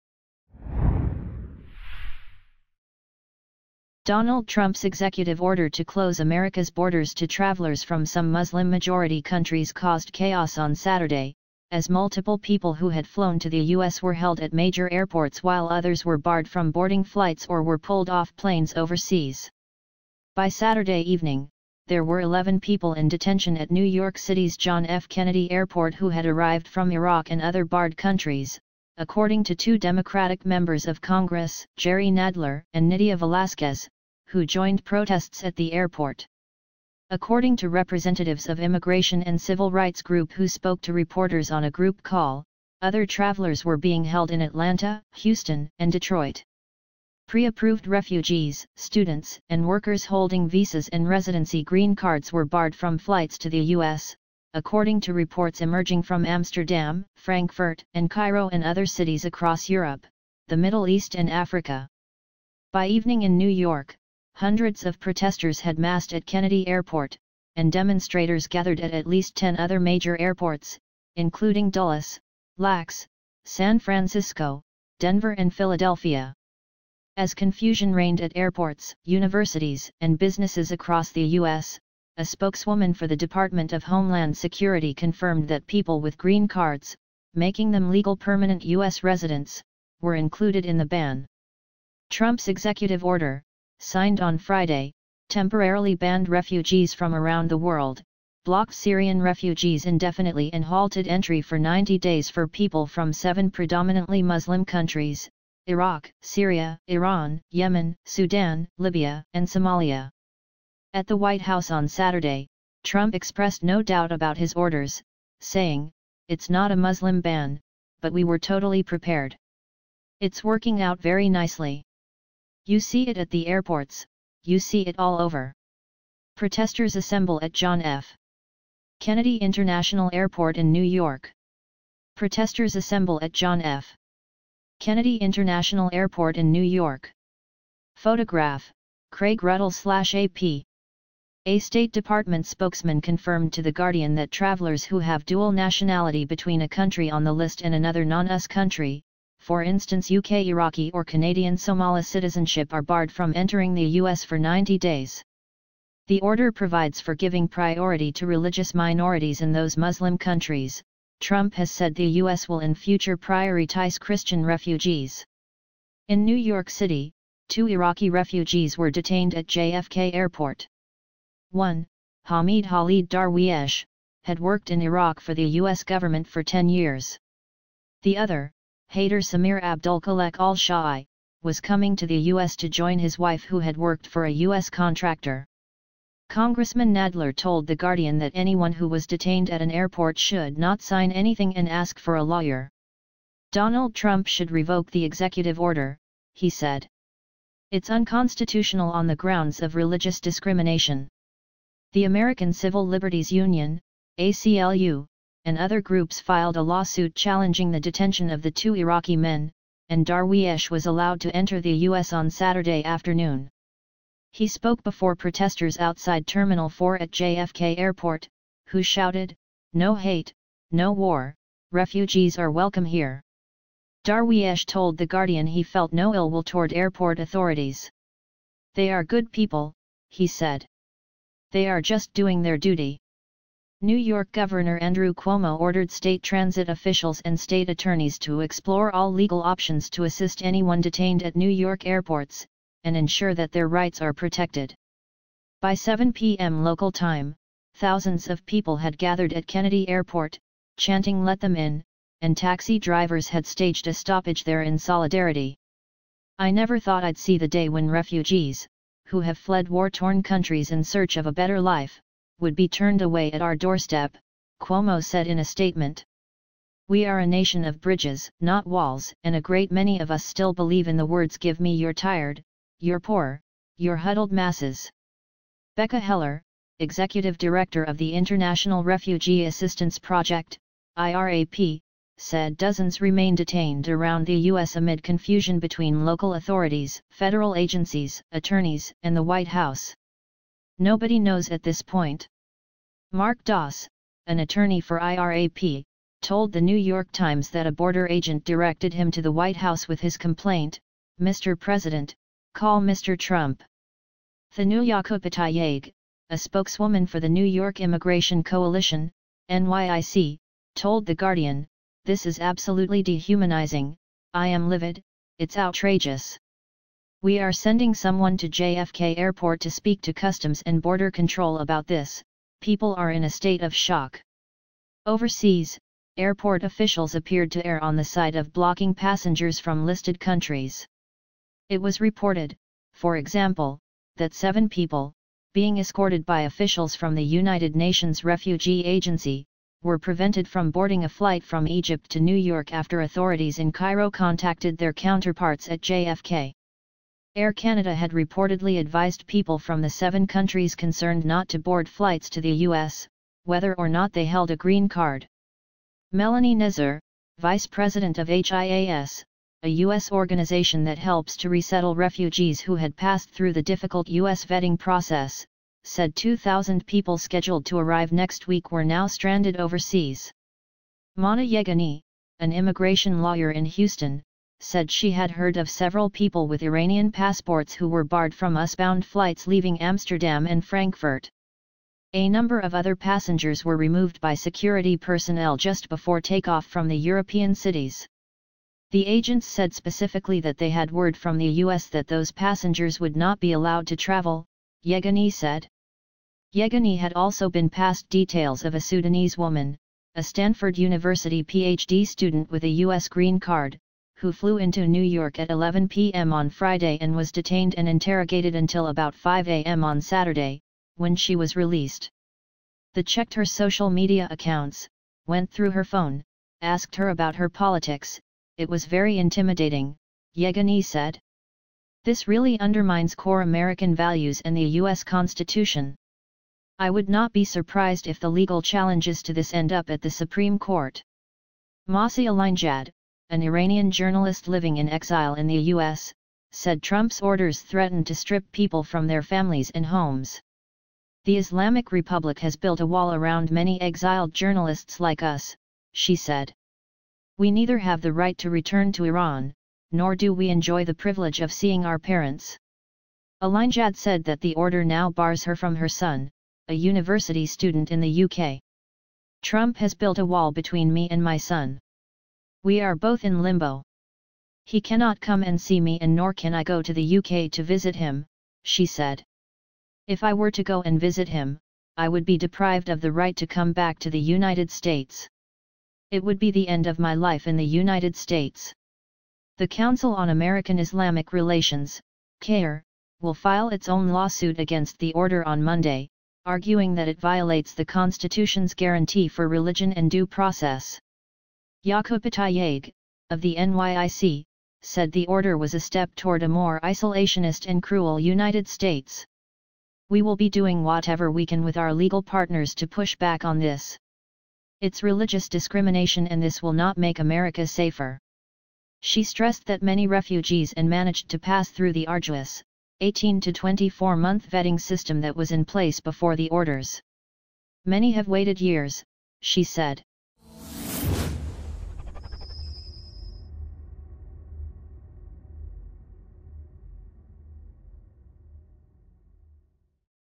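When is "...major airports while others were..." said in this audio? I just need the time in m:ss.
0:14.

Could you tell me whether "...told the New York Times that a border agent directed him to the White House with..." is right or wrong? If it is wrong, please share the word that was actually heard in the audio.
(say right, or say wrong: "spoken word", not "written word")
right.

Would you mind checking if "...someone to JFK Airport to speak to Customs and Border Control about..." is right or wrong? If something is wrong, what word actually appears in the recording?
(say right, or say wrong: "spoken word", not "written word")
right.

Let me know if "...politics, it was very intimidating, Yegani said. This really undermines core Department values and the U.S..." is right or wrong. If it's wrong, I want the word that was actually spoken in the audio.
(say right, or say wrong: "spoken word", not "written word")
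wrong: "American", not "Department".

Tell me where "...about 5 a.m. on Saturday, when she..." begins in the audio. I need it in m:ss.
6:48.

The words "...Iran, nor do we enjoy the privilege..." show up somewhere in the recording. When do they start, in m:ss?
7:29.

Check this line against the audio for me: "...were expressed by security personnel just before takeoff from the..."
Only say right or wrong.
wrong.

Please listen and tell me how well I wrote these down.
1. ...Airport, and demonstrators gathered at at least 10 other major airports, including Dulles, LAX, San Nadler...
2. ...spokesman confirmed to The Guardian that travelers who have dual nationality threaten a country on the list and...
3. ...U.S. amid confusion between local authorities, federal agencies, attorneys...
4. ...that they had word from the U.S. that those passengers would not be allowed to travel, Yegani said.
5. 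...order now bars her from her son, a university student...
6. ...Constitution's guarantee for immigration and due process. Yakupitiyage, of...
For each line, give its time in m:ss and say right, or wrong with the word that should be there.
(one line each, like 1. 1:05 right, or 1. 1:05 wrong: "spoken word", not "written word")
1. 1:06 wrong: "Francisco", not "Nadler"
2. 2:22 wrong: "between", not "threaten"
3. 4:44 right
4. 6:30 right
5. 7:34 right
6. 8:07 wrong: "religion", not "immigration".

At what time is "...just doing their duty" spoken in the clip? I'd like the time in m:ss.
3:51.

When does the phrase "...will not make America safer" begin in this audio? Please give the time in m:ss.
8:26.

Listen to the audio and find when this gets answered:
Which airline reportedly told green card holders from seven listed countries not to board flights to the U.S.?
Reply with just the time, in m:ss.
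5:47.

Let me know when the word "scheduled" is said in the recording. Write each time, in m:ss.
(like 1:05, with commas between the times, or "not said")
6:07.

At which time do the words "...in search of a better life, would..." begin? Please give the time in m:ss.
4:20.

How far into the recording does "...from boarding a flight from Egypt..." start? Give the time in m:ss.
5:40.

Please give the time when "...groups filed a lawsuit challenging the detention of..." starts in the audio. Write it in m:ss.
3:25.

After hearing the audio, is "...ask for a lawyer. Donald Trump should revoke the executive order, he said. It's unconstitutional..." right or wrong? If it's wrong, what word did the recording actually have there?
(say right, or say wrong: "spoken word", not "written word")
right.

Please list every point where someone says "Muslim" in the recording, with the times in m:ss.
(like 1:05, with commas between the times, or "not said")
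0:08, 1:44, 1:56, 2:39.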